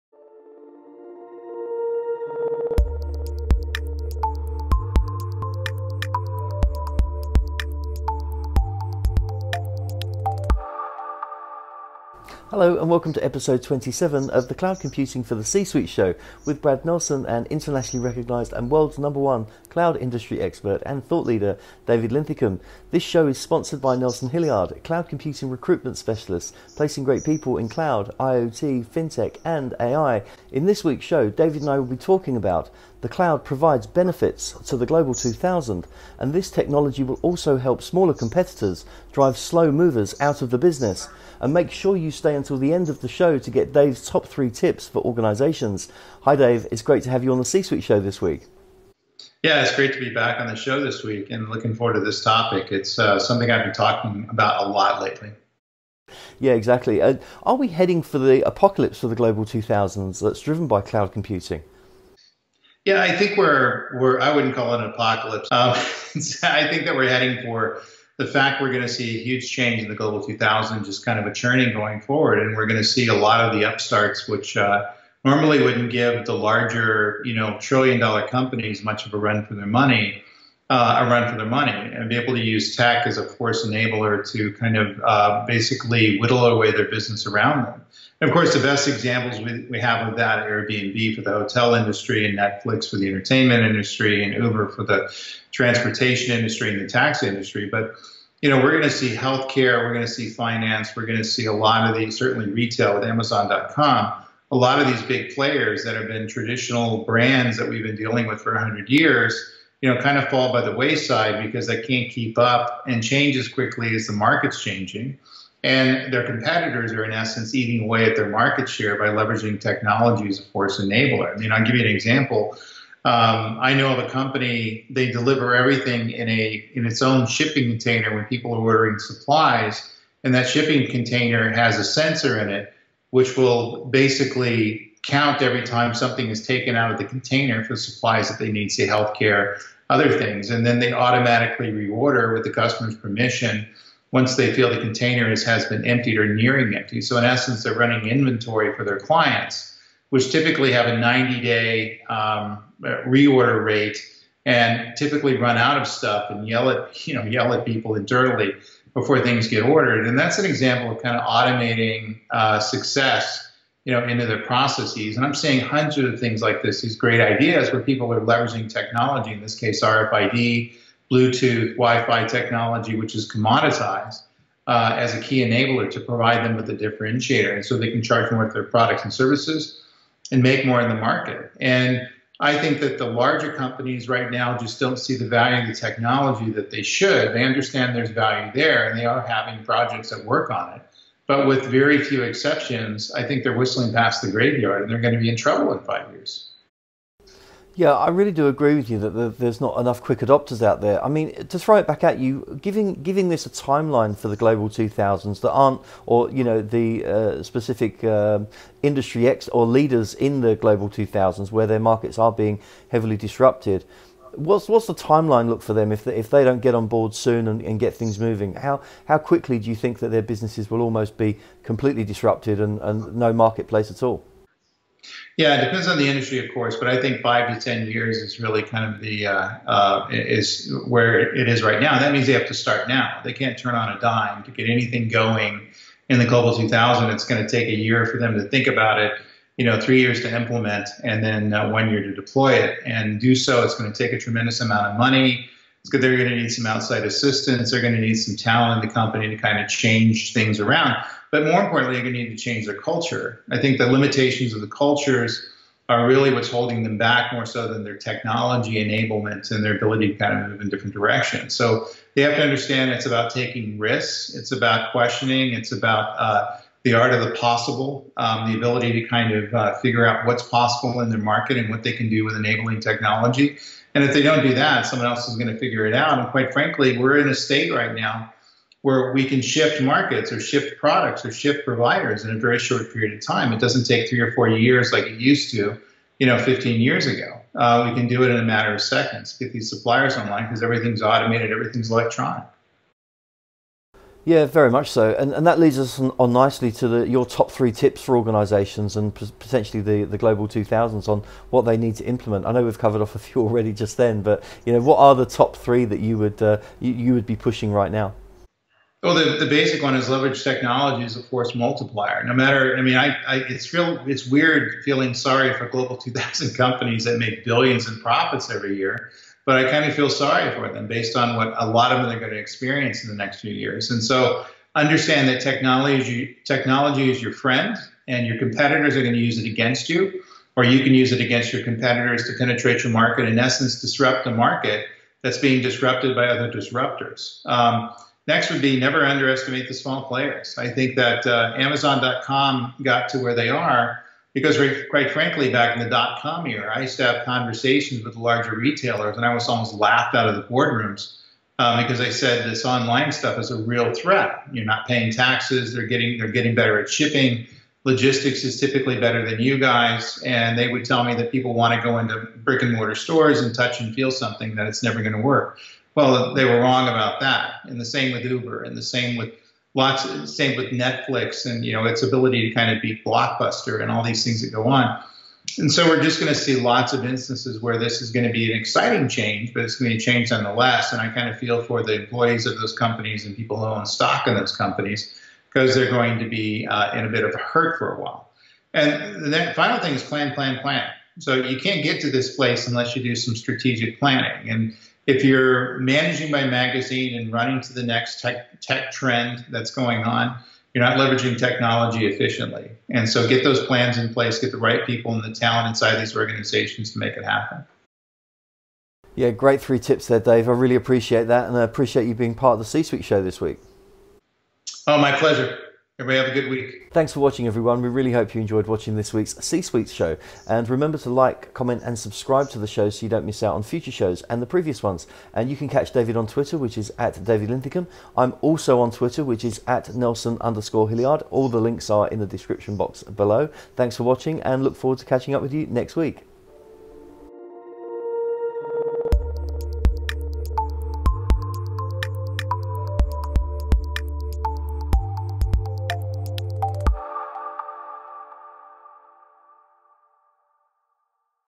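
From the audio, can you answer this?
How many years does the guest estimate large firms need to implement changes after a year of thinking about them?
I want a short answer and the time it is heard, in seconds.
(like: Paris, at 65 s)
3 years, at 239 s.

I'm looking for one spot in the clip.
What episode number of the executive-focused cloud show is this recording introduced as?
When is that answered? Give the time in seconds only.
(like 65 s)
13 s.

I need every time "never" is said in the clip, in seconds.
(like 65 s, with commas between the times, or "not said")
338 s, 364 s.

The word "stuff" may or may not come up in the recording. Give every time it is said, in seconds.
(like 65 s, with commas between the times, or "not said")
155 s, 353 s.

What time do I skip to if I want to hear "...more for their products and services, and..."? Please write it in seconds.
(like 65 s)
178 s.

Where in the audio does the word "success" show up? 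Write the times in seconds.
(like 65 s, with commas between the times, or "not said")
162 s.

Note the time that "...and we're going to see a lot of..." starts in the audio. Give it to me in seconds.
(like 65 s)
72 s.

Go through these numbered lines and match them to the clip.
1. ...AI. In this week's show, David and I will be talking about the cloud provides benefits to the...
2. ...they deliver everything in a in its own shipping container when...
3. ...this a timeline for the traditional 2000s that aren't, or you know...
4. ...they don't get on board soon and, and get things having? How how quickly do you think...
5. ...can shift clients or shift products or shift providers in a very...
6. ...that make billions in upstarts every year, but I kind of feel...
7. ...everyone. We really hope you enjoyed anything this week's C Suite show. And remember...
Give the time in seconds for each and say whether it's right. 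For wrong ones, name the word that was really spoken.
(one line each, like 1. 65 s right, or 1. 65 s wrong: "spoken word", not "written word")
1. 29 s right
2. 124 s right
3. 203 s wrong: "global", not "traditional"
4. 216 s wrong: "moving", not "having"
5. 279 s wrong: "markets", not "clients"
6. 317 s wrong: "profits", not "upstarts"
7. 417 s wrong: "watching", not "anything".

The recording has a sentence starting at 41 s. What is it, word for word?
And make sure you stay until the end of the show to get Dave's top three tips for organizations.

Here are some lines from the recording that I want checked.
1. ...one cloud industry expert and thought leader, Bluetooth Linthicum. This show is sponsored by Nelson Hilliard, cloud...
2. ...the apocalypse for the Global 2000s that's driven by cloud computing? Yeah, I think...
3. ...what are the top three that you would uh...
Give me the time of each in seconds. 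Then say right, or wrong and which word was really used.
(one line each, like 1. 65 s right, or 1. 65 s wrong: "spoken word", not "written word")
1. 19 s wrong: "David", not "Bluetooth"
2. 58 s right
3. 304 s right.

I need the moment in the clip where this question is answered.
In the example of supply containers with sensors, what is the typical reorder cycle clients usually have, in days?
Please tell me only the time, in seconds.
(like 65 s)
150 s.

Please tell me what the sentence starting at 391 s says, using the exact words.
So you can't get to this place unless you do some strategic planning.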